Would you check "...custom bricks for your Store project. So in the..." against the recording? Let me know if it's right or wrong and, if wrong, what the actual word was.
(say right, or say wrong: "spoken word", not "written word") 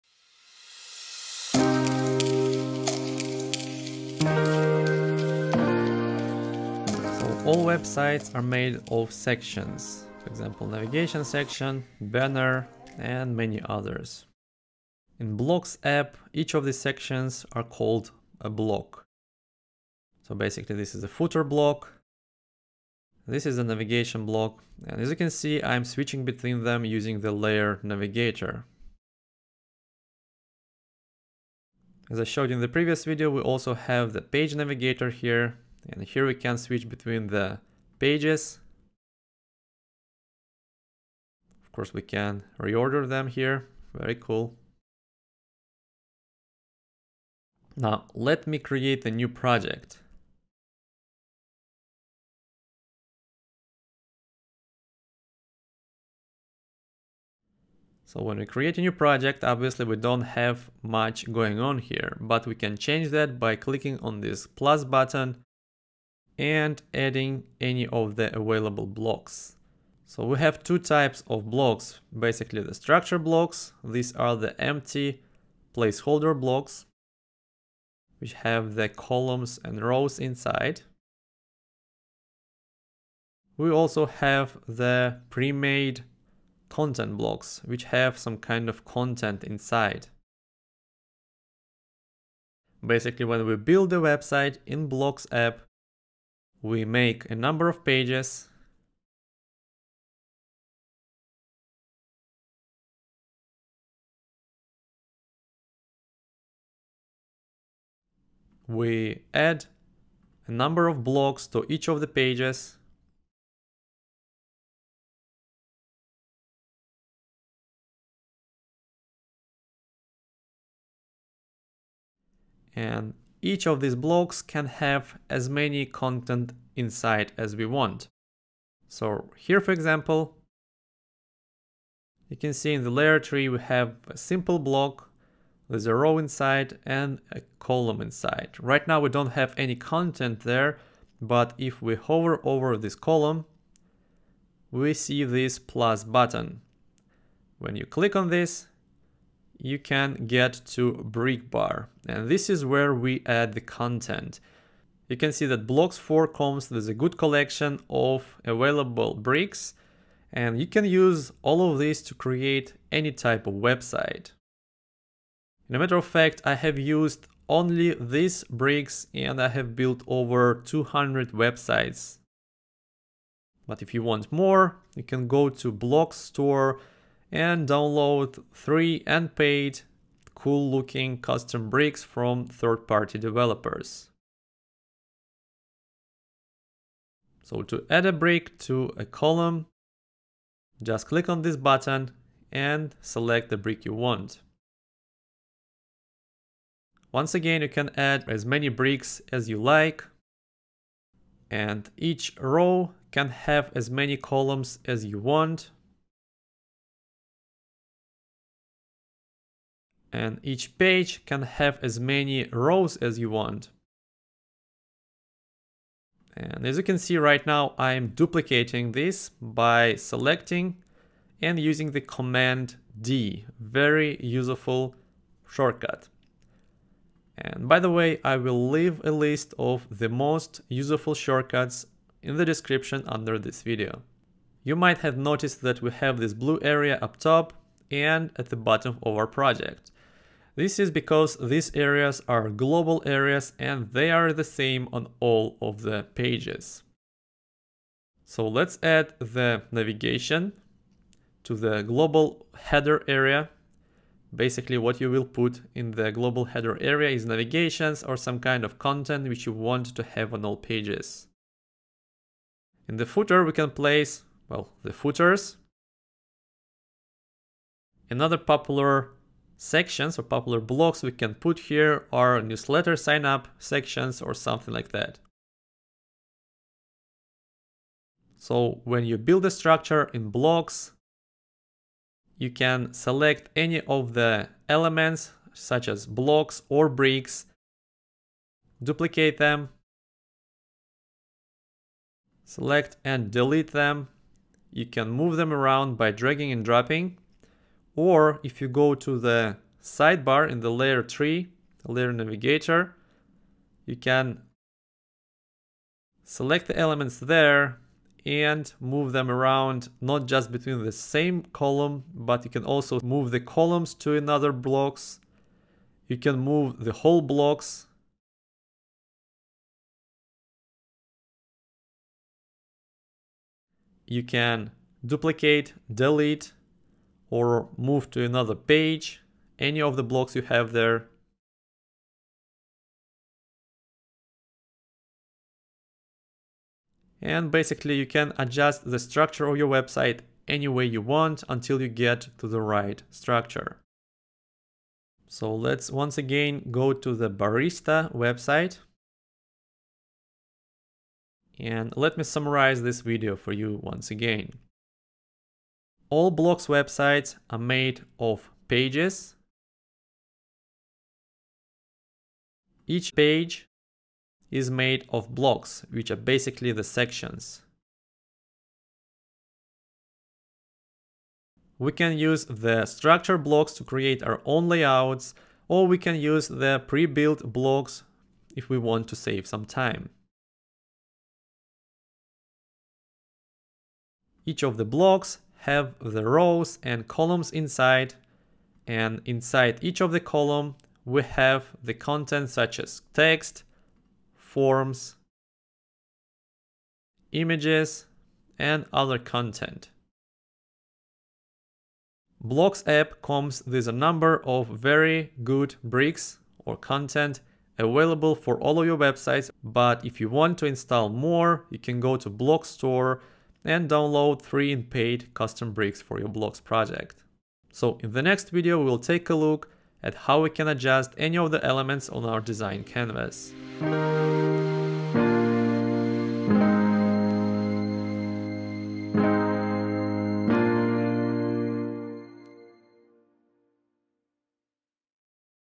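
wrong: "Blocs", not "Store".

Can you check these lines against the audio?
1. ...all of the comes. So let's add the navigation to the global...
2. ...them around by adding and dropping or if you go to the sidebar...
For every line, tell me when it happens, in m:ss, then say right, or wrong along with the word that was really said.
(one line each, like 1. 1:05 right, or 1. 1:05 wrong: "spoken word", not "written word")
1. 4:05 wrong: "pages", not "comes"
2. 4:55 wrong: "dragging", not "adding".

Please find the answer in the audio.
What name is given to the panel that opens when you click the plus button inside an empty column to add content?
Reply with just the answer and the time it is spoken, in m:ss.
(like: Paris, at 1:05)
brick bar, at 2:30.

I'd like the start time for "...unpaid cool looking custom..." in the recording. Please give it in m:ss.
2:59.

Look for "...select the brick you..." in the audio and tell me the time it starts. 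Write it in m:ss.
3:13.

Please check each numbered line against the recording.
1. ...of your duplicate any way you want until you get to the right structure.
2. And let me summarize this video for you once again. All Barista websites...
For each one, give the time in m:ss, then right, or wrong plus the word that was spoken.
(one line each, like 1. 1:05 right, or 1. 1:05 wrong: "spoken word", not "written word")
1. 5:39 wrong: "website", not "duplicate"
2. 5:51 wrong: "Blocs", not "Barista".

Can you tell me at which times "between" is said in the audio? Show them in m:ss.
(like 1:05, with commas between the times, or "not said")
0:26, 0:36, 5:10.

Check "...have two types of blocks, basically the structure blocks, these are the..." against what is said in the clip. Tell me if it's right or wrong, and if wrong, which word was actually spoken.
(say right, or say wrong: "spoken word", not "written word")
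right.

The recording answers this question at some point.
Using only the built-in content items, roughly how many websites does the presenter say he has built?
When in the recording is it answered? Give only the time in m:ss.
2:50.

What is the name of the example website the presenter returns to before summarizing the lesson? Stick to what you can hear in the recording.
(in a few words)
Barista.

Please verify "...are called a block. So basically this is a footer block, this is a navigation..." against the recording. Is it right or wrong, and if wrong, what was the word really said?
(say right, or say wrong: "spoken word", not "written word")
right.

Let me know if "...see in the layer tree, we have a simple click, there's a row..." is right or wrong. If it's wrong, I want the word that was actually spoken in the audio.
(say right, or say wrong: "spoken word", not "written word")
wrong: "block", not "click".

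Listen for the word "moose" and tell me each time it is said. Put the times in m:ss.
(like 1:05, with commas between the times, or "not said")
not said.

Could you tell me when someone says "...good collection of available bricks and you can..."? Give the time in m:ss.
2:36.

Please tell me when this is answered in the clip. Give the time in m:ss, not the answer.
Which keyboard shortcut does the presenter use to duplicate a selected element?
3:42.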